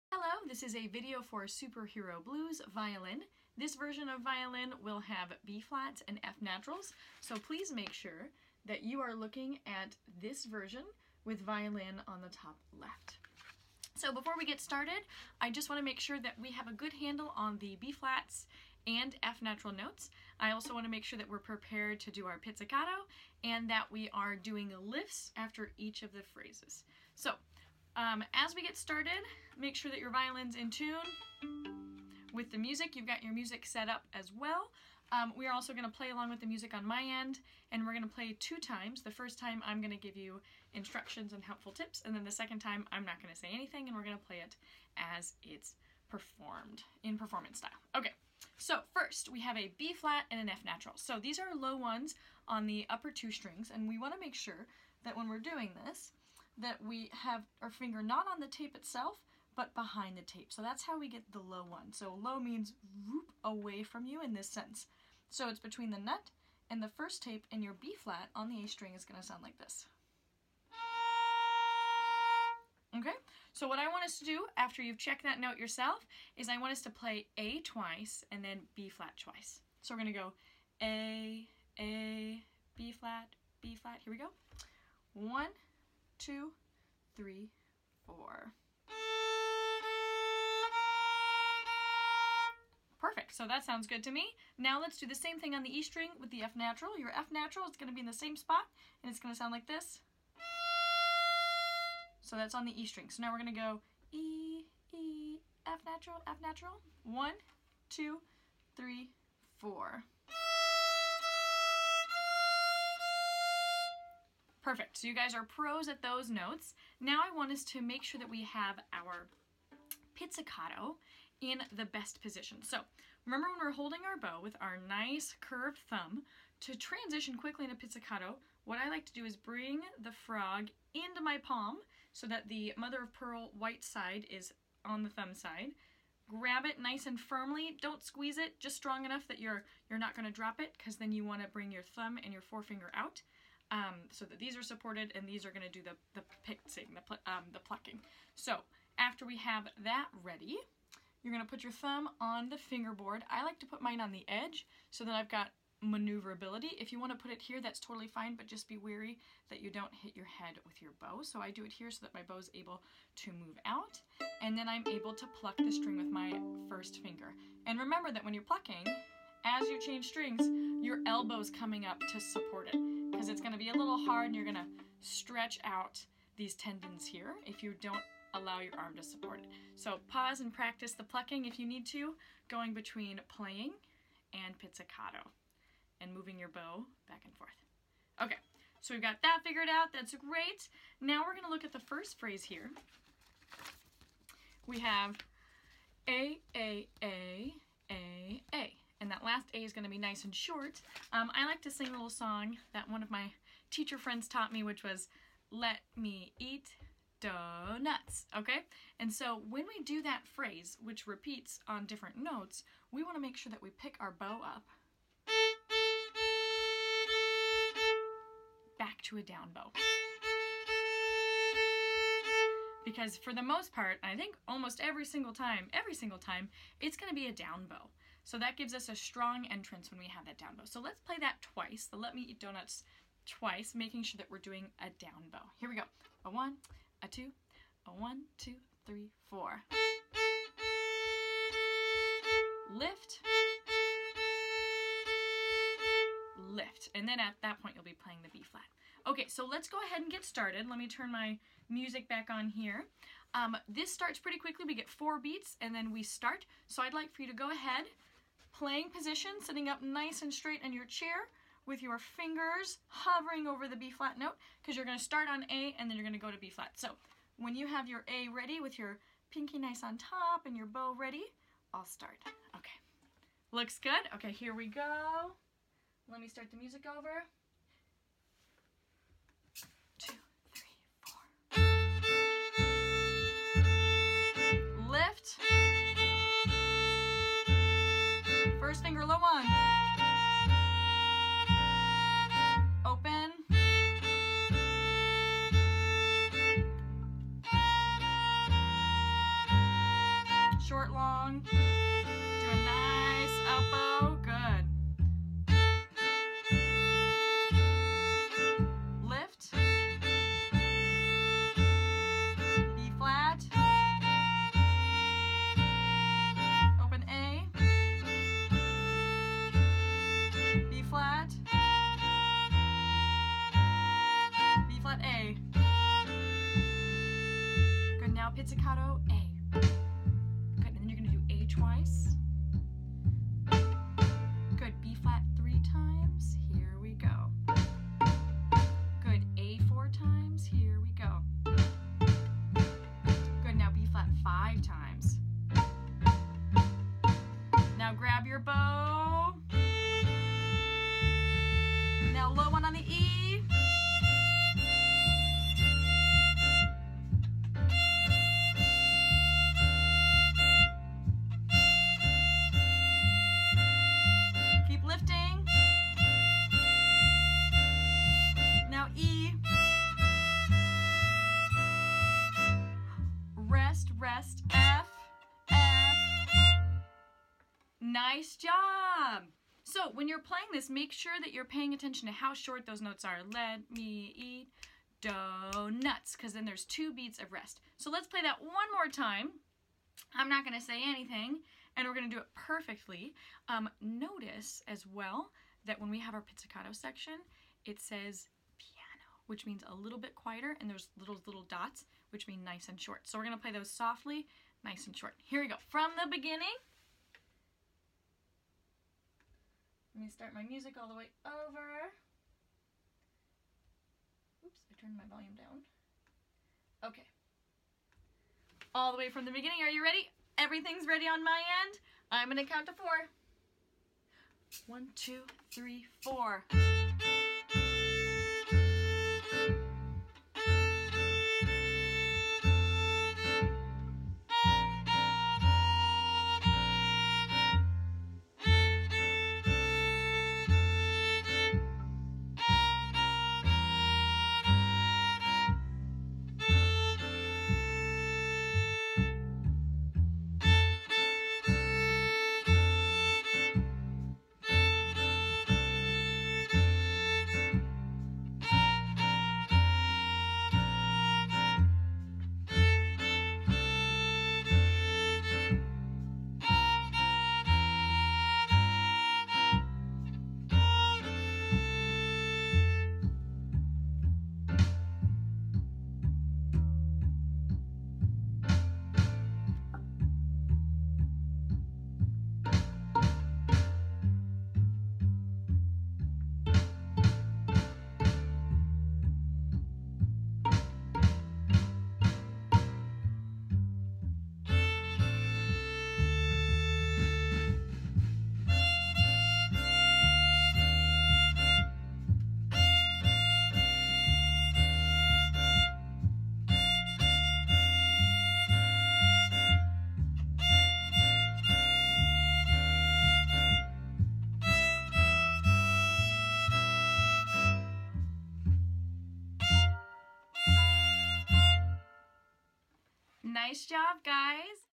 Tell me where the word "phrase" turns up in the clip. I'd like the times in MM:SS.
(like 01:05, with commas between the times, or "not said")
00:26, 03:12, 03:30.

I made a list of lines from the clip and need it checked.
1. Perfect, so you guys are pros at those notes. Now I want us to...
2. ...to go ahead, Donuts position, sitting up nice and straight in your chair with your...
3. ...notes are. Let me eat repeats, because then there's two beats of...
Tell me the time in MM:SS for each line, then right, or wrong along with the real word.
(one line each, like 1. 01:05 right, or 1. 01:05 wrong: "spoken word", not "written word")
1. 01:54 right
2. 04:17 wrong: "Playing", not "Donuts"
3. 06:22 wrong: "donuts", not "repeats".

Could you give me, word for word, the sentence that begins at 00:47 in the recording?
Okay, so first we have a B flat and an F natural.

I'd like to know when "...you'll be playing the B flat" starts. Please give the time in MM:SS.
04:07.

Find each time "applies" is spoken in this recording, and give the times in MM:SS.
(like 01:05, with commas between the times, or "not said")
not said.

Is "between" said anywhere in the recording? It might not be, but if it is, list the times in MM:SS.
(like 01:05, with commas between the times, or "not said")
01:05, 03:02.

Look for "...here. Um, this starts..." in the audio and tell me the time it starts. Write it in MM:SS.
04:12.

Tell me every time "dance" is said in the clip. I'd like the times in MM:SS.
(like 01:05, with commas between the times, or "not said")
not said.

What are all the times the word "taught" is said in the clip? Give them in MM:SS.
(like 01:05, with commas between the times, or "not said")
03:24.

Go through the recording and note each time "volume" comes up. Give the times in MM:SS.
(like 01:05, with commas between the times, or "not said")
06:55.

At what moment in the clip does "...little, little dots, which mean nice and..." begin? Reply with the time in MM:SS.
06:40.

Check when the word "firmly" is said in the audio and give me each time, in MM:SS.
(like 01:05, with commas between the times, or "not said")
02:17.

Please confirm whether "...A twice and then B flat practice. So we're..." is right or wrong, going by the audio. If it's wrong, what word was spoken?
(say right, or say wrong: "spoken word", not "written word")
wrong: "twice", not "practice".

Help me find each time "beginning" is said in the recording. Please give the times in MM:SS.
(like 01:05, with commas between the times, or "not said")
06:46, 06:59.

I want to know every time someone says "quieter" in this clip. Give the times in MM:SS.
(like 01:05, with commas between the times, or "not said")
06:40.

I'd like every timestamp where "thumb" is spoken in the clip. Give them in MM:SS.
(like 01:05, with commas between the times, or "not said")
02:05, 02:15, 02:21, 02:31.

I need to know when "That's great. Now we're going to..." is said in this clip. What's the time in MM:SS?
03:09.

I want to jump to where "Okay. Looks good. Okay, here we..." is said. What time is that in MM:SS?
04:32.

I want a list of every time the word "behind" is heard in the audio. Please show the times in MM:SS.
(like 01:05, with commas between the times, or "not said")
00:59.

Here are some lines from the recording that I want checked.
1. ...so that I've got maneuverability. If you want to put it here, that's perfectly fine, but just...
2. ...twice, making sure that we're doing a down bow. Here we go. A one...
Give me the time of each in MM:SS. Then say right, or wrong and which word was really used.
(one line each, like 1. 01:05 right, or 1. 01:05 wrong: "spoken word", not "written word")
1. 02:34 wrong: "totally", not "perfectly"
2. 03:53 right.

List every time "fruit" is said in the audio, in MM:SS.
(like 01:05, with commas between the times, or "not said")
not said.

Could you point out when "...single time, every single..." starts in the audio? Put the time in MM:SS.
03:45.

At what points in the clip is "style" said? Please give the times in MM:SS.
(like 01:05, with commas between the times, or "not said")
00:47.